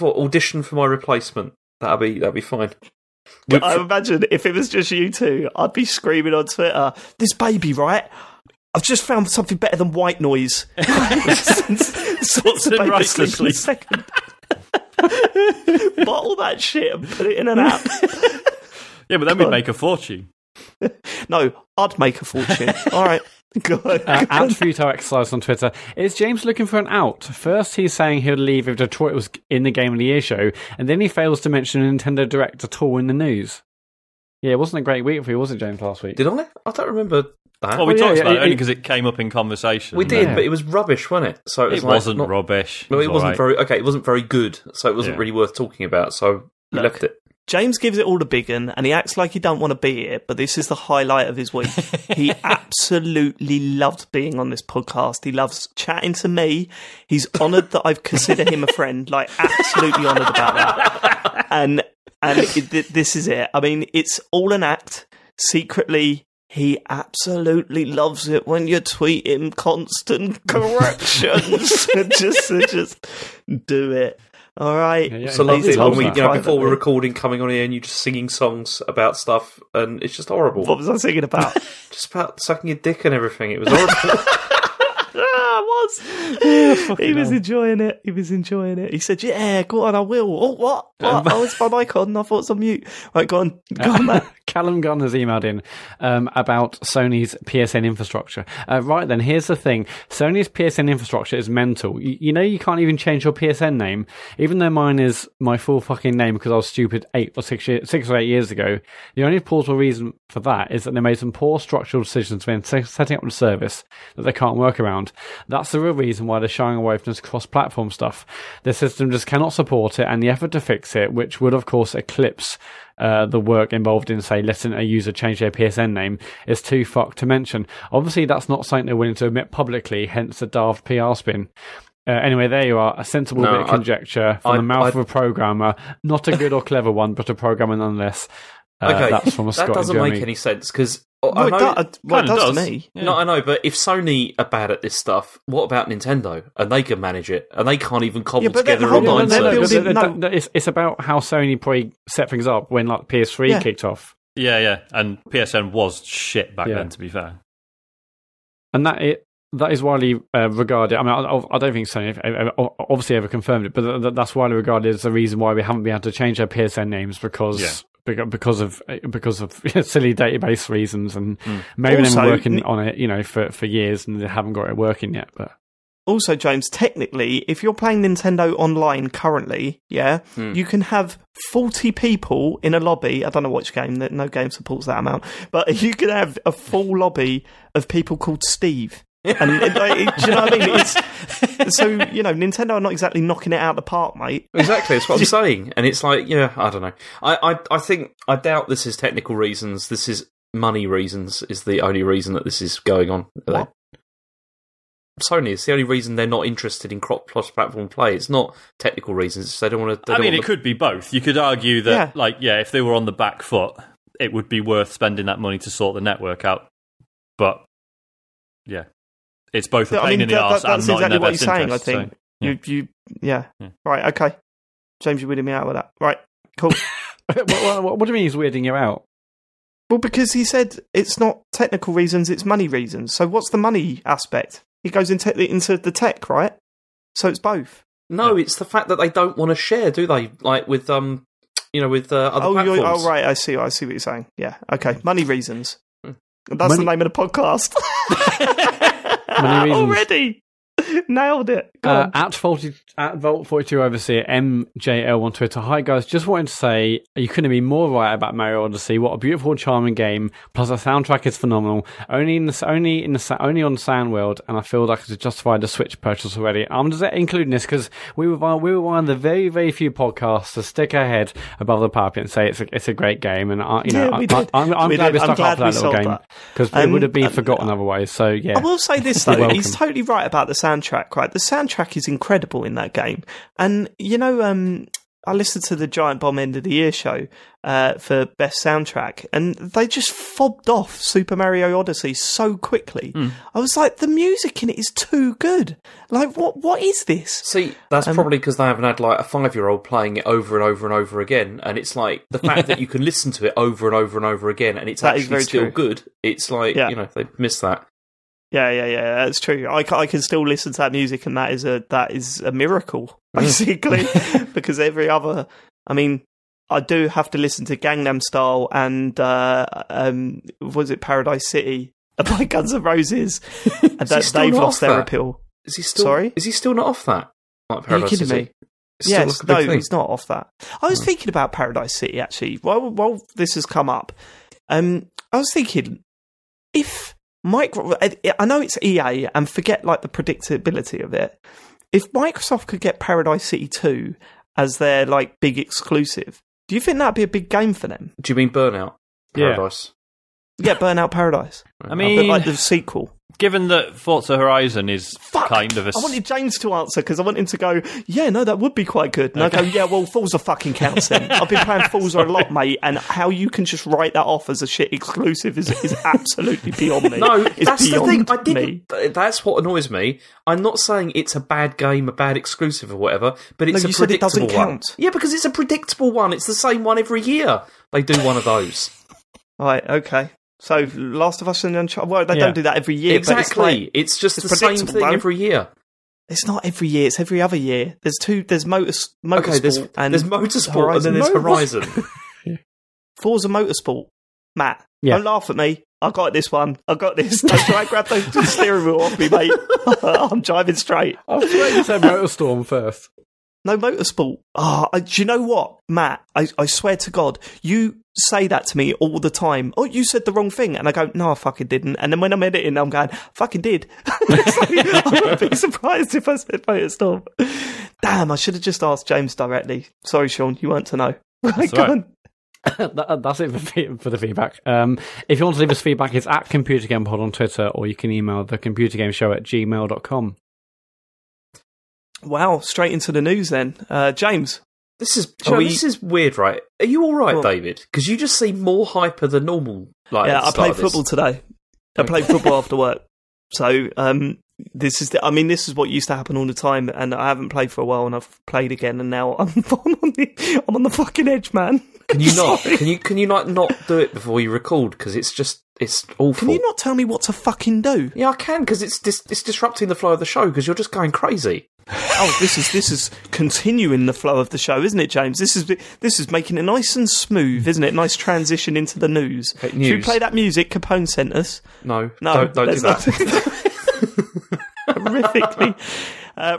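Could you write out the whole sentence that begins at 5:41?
If Microsoft could get Paradise City two as their like big exclusive, do you think that'd be a big game for them?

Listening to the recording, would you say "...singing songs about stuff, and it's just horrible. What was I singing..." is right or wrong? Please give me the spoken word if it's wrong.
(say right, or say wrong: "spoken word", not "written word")
right.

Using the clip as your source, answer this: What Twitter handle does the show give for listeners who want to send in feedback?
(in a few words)
Computer Game Pod.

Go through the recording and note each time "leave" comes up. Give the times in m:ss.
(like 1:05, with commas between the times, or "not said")
0:28, 7:05.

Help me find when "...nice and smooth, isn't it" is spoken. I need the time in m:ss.
7:46.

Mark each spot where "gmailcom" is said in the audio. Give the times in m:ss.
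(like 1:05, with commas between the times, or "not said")
7:09.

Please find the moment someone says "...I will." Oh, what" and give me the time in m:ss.
1:29.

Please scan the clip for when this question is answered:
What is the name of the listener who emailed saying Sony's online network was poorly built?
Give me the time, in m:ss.
1:34.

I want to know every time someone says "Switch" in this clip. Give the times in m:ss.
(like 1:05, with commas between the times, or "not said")
4:25.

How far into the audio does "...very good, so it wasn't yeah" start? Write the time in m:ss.
0:44.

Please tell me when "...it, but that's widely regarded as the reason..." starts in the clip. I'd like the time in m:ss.
2:43.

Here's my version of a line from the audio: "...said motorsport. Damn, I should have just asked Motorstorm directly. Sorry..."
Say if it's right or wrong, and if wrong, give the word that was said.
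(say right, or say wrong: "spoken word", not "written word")
wrong: "James", not "Motorstorm".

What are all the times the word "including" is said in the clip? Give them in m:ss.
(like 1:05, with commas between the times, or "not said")
4:27.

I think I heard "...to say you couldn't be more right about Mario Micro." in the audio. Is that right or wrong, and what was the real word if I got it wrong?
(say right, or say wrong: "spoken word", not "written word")
wrong: "Odyssey", not "Micro".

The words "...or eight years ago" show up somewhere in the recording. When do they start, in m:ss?
1:48.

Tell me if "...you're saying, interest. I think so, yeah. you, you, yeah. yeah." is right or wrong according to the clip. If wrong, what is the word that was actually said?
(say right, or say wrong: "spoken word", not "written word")
right.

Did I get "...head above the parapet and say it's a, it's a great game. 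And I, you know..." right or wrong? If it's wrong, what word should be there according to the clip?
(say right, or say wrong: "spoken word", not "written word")
right.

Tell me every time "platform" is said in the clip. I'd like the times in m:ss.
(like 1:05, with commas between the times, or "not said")
1:57, 3:27, 4:02.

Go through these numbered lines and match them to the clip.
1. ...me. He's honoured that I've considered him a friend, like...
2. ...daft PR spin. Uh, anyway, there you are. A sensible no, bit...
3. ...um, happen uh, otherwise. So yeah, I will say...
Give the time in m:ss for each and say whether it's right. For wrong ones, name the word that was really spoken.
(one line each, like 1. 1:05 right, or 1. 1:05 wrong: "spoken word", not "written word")
1. 0:56 right
2. 2:10 right
3. 4:37 wrong: "forgotten", not "happen".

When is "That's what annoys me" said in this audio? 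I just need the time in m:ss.
6:09.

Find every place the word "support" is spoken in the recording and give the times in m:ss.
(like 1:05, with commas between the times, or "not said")
1:59, 3:04.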